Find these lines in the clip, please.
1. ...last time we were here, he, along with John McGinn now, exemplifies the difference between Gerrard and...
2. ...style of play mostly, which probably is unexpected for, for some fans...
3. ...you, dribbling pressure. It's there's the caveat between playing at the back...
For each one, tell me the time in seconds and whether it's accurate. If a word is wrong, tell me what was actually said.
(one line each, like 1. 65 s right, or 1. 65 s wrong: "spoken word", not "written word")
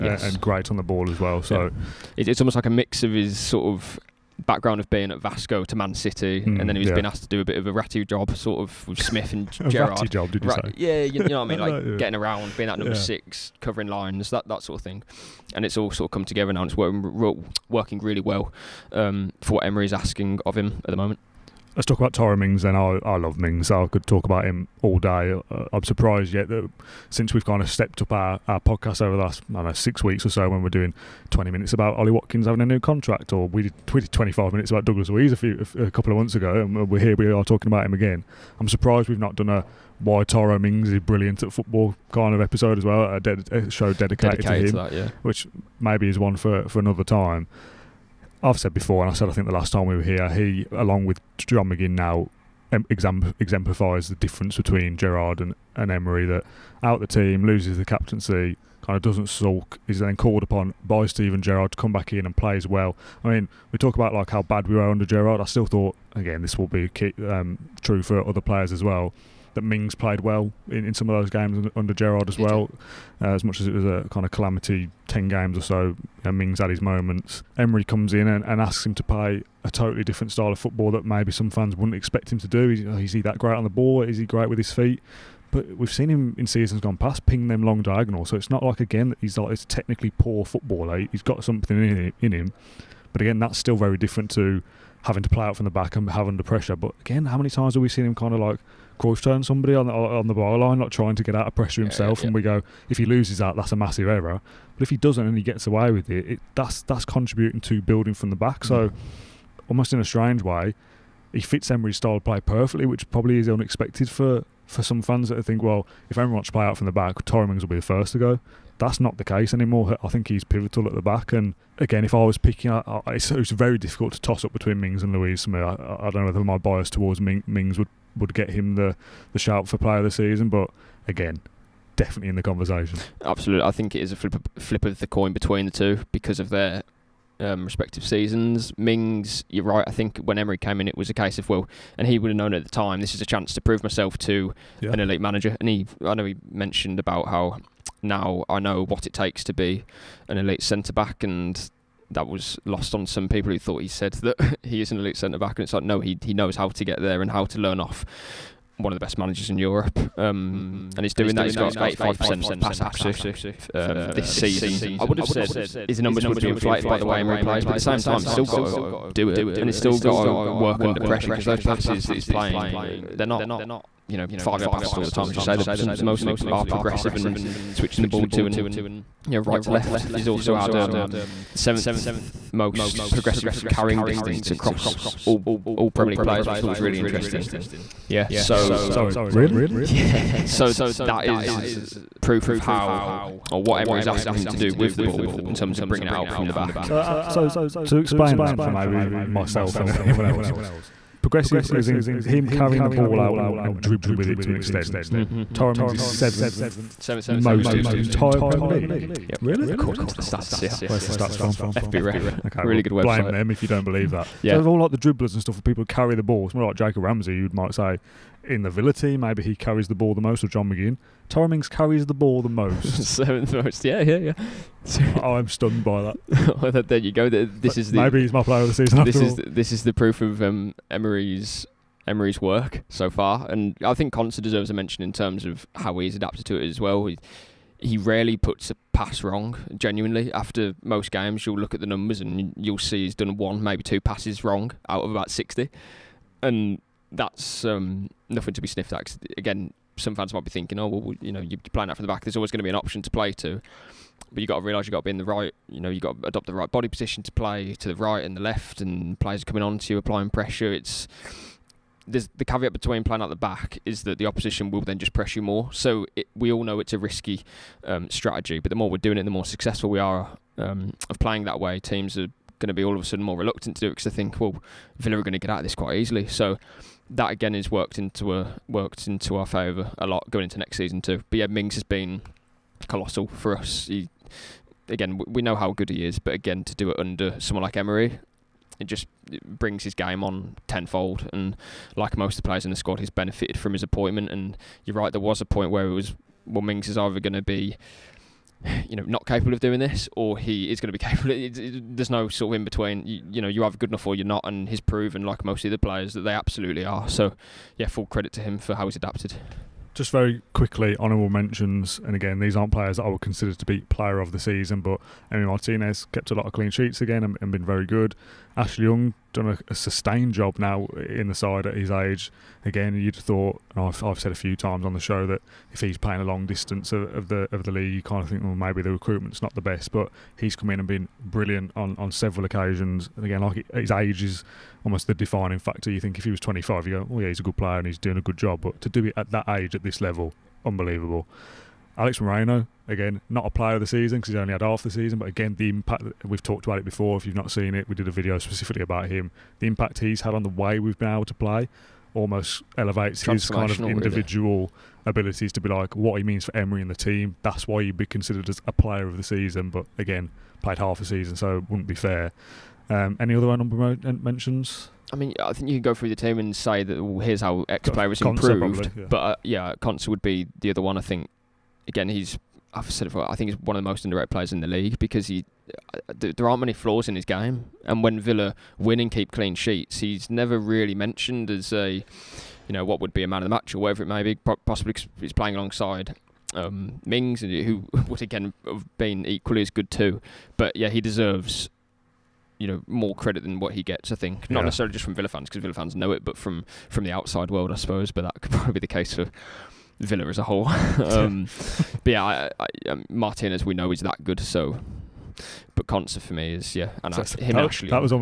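1. 49 s right
2. 111 s wrong: "perfectly", not "mostly"
3. 259 s wrong: "applying", not "dribbling".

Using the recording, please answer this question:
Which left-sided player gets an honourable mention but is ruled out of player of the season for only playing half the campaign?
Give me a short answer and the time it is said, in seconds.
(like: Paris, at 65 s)
Alex Moreno, at 341 s.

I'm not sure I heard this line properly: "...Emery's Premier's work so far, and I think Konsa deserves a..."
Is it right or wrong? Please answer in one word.
wrong.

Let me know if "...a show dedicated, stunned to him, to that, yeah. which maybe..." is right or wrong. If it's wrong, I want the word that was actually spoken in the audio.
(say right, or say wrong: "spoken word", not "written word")
wrong: "dedicated", not "stunned".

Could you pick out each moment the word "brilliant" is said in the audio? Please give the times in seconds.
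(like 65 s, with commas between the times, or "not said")
40 s, 331 s.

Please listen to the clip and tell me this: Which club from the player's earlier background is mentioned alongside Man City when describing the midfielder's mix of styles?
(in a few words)
Vasco.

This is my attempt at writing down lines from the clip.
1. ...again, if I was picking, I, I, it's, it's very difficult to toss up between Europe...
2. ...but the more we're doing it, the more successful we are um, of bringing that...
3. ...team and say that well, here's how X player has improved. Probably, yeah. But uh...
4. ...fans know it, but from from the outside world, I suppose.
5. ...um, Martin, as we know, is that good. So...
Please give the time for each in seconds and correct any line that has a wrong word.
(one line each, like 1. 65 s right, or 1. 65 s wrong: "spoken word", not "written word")
1. 121 s wrong: "Mings", not "Europe"
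2. 268 s wrong: "playing", not "bringing"
3. 366 s right
4. 395 s right
5. 402 s right.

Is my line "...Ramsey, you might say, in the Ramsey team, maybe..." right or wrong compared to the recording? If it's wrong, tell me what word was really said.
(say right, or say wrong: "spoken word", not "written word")
wrong: "Villa", not "Ramsey".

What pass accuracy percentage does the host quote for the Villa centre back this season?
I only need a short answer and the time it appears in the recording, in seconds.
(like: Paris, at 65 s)
85%, at 161 s.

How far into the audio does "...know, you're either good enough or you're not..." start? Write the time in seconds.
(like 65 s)
303 s.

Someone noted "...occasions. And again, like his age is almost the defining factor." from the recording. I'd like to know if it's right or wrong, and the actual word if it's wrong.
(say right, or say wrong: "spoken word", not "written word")
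right.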